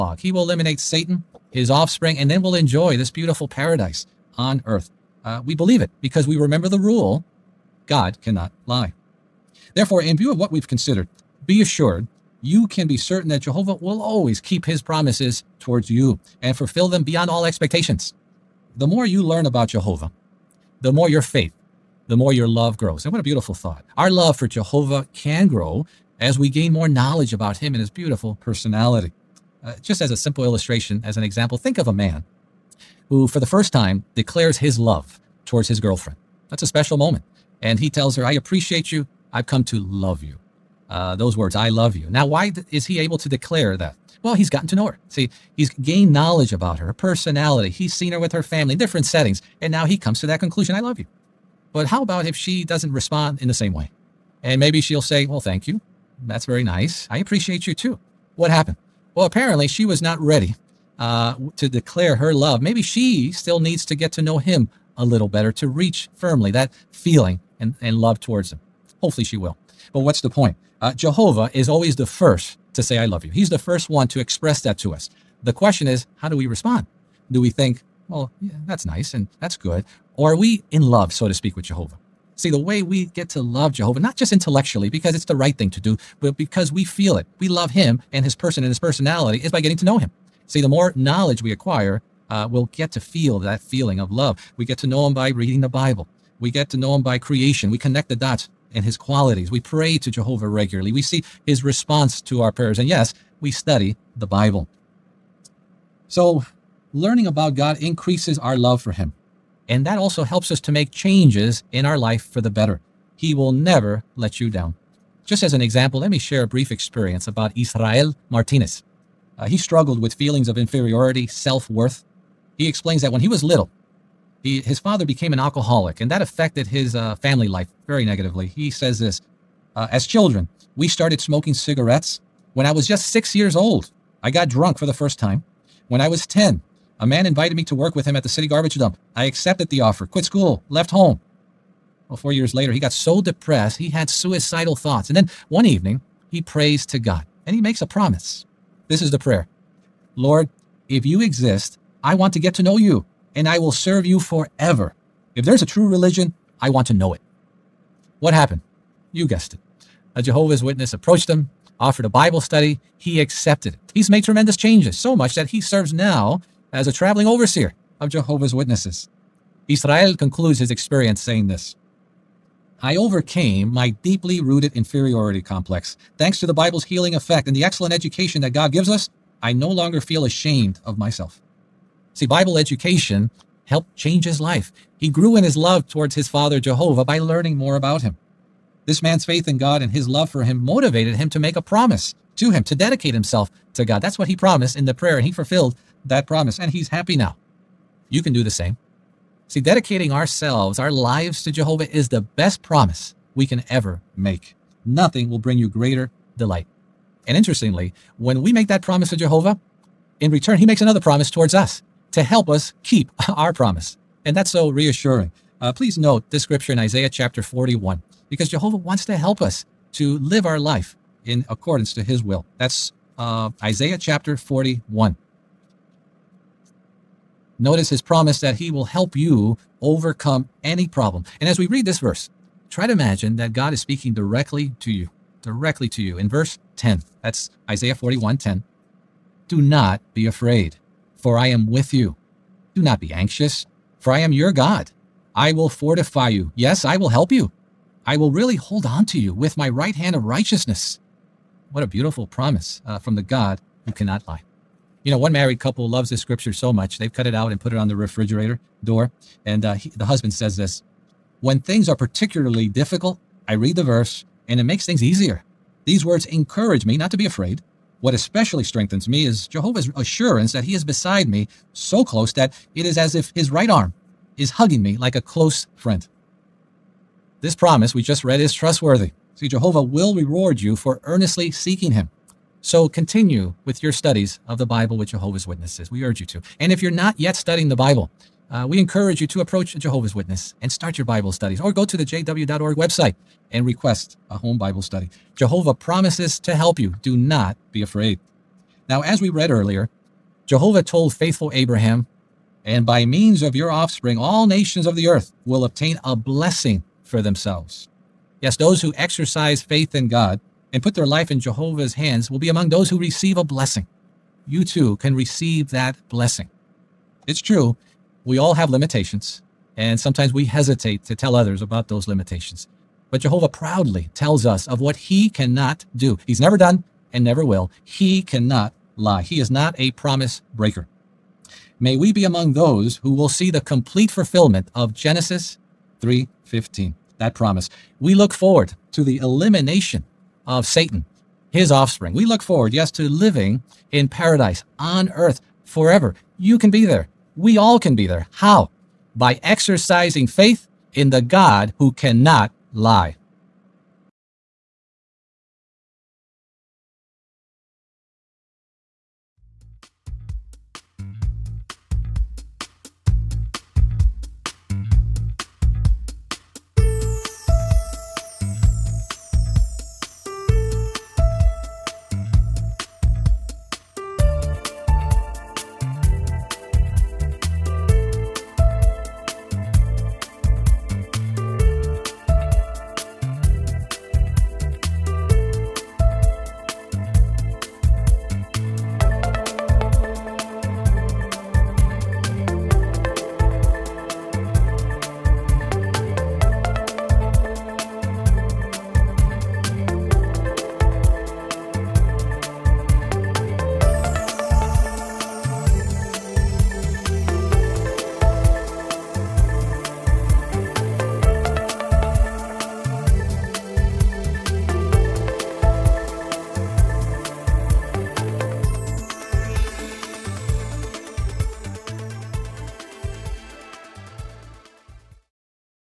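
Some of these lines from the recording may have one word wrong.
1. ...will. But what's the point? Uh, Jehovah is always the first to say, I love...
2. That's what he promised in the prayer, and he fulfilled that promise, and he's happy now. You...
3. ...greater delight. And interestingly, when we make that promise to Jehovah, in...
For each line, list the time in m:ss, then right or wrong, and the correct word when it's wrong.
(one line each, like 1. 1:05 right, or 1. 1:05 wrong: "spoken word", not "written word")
1. 1:09 right
2. 3:14 right
3. 3:25 right.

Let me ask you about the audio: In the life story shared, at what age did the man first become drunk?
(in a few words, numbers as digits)
6.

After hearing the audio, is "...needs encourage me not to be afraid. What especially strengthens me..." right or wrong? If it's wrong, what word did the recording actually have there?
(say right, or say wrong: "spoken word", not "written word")
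wrong: "words", not "needs".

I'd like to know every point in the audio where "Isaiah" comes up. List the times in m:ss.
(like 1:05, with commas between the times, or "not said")
3:36, 3:43, 3:57.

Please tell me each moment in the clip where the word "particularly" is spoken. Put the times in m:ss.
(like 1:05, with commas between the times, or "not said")
4:21.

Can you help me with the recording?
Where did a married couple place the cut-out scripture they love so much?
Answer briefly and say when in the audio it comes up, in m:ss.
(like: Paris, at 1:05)
Refrigerator door, at 4:17.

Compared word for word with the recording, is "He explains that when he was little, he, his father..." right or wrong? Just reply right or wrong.
right.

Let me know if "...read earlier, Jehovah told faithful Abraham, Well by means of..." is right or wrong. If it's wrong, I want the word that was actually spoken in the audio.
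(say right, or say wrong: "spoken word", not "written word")
wrong: "And", not "Well".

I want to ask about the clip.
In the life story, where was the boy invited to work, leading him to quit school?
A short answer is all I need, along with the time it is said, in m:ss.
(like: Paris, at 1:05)
City garbage dump, at 2:18.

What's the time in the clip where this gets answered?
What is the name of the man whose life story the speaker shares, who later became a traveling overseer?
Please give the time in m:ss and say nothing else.
1:57.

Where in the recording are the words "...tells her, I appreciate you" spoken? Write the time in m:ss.
0:37.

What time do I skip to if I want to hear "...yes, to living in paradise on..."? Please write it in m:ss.
5:42.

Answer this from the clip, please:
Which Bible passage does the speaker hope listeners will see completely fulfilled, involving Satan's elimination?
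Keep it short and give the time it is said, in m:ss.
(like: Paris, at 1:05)
Genesis 3:15, at 5:34.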